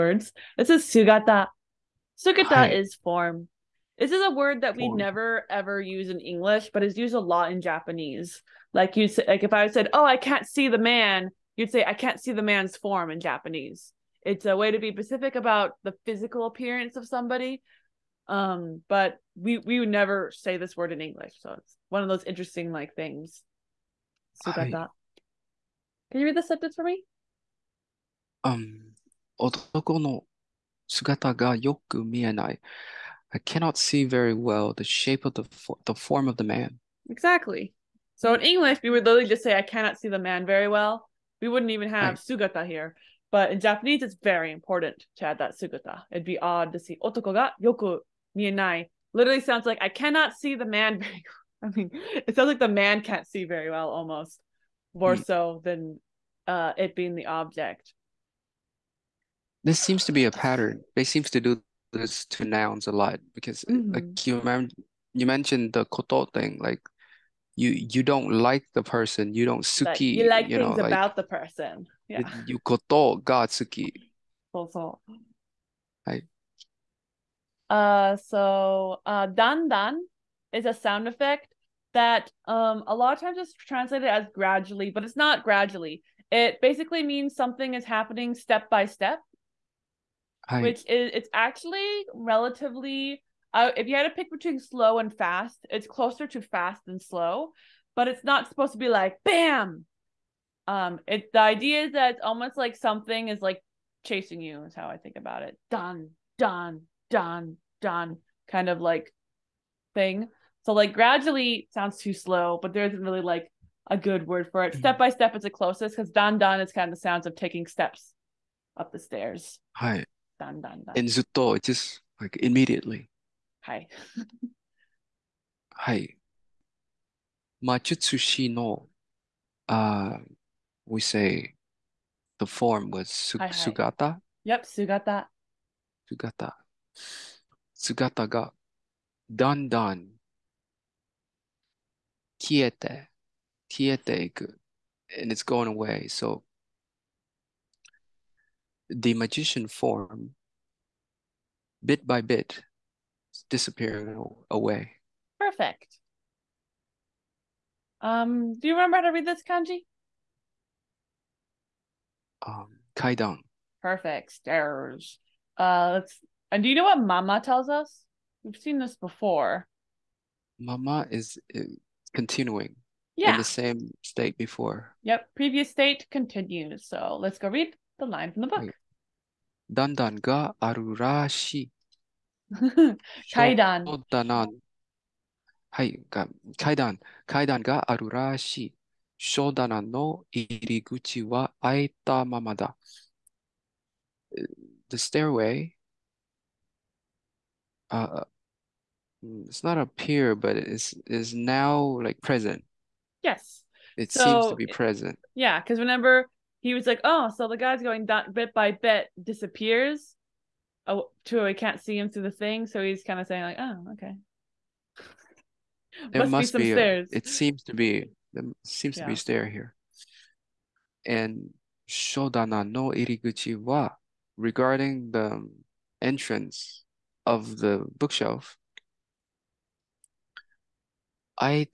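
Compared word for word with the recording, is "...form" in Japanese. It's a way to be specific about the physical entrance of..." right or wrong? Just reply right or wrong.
wrong.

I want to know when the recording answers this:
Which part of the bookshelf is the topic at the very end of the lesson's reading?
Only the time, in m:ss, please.
3:46.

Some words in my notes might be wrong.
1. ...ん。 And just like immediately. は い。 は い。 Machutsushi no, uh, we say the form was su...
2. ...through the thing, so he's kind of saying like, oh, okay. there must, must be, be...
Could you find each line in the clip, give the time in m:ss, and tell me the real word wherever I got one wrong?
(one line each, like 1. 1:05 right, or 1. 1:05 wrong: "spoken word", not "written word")
1. 2:00 right
2. 3:32 right.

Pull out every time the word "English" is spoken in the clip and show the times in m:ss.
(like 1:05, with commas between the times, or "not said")
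0:06, 0:20, 0:38.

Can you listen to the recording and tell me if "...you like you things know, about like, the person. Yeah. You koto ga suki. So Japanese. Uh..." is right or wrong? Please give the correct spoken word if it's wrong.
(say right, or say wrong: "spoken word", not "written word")
wrong: "Right", not "Japanese".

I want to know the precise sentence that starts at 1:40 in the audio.
Um, it the idea is that it's almost like something is like chasing you is how I think about it.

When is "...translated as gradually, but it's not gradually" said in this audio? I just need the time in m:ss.
1:23.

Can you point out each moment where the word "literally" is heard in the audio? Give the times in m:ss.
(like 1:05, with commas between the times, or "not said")
0:39, 0:49.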